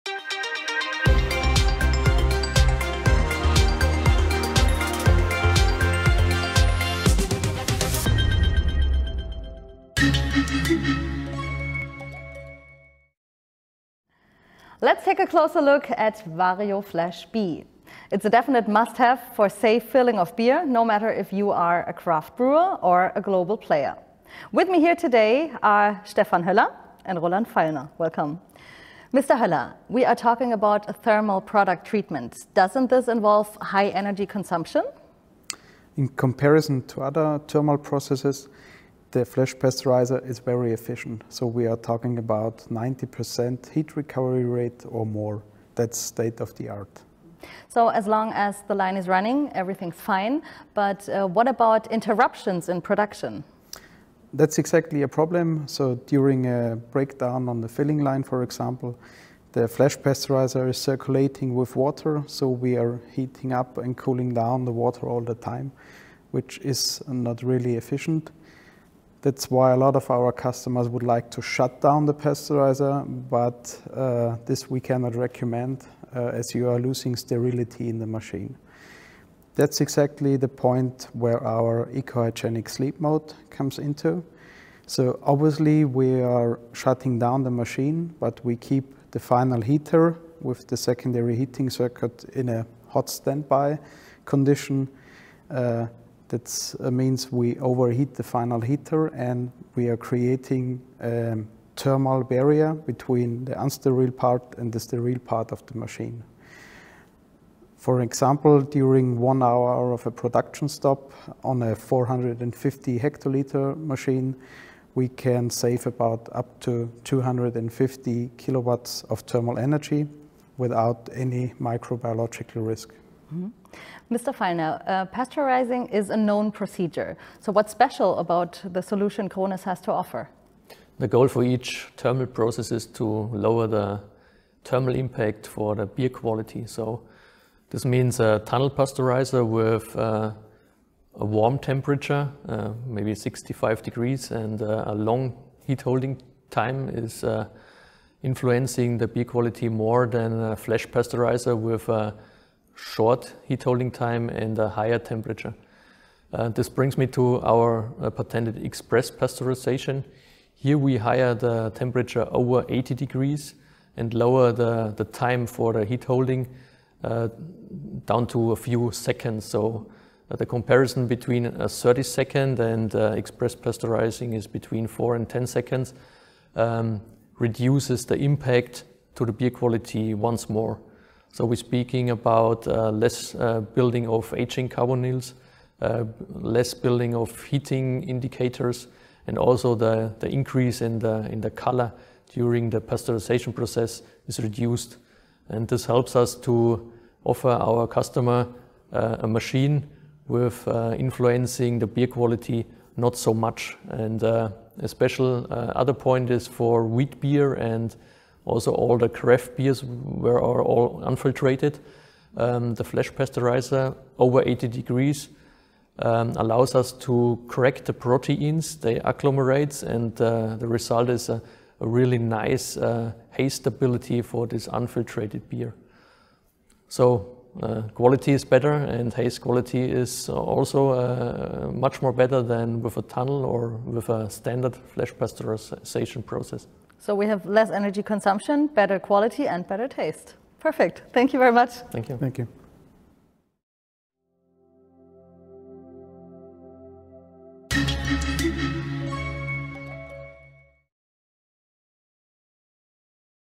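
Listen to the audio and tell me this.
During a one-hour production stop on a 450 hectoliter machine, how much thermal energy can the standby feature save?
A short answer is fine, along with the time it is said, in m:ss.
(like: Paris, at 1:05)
250 kilowatts, at 1:57.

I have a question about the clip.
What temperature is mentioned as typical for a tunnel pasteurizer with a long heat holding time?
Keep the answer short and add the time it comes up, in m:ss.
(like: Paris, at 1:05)
65 degrees, at 2:23.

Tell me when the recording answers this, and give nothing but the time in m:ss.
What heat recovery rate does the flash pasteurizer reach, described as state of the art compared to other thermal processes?
0:42.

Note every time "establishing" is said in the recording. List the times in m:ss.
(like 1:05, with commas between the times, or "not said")
not said.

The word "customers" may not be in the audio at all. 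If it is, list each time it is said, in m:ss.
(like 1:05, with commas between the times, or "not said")
1:10, 3:17.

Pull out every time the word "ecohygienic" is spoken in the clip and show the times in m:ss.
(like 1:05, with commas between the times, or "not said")
1:21.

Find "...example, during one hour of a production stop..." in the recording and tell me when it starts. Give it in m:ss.
1:48.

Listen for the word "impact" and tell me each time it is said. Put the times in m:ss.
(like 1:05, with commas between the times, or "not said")
2:14, 2:58.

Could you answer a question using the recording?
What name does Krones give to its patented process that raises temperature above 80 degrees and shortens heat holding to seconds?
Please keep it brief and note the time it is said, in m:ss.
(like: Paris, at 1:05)
express pasteurization, at 2:38.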